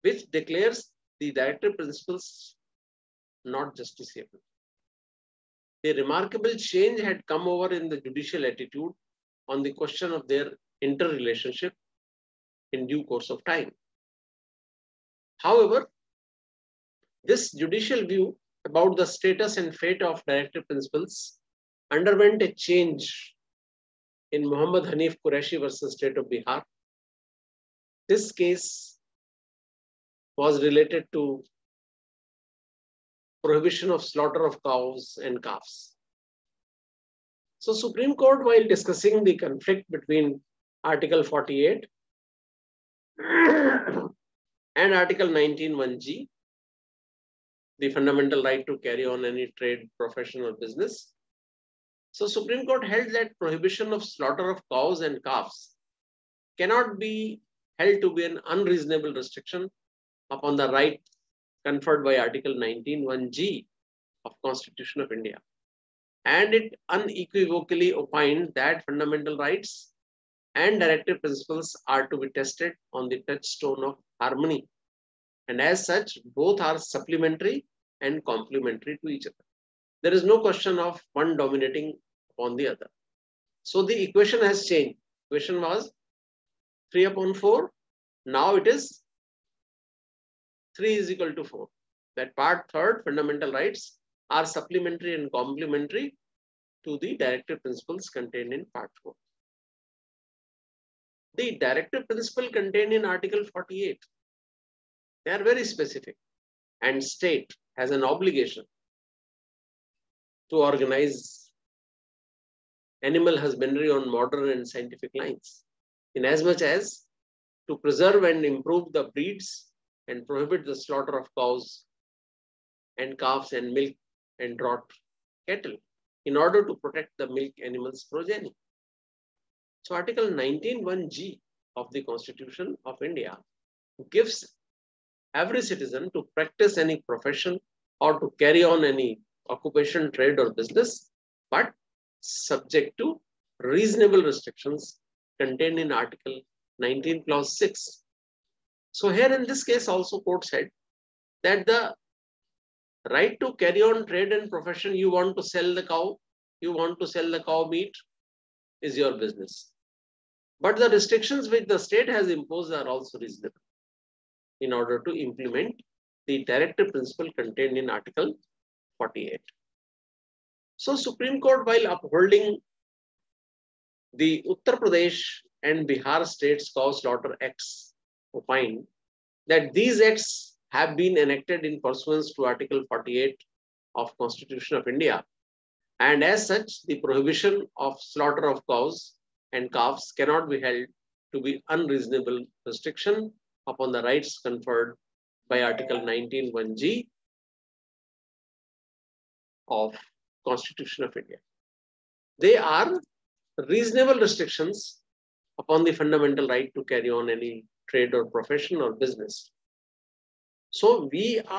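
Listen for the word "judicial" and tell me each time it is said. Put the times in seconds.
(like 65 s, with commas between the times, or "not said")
7 s, 17 s.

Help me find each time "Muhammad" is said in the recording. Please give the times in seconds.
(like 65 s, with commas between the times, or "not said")
24 s.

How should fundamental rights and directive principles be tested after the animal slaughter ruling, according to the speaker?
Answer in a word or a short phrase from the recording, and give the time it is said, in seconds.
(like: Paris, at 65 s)
On the touchstone of harmony, at 73 s.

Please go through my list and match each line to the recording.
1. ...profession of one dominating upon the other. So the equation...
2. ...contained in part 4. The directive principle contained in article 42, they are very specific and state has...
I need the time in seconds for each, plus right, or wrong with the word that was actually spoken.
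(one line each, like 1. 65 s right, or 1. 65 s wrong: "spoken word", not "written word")
1. 80 s wrong: "question", not "profession"
2. 98 s wrong: "48", not "42".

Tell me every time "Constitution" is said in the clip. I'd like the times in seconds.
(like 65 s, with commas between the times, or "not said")
64 s, 132 s, 184 s, 200 s.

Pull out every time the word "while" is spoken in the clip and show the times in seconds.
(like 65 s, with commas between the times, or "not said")
38 s, 171 s.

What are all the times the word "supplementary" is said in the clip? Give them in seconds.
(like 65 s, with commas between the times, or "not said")
76 s, 94 s.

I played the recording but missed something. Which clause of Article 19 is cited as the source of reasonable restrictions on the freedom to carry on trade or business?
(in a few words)
Clause 6.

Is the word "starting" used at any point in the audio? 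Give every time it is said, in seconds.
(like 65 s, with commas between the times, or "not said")
not said.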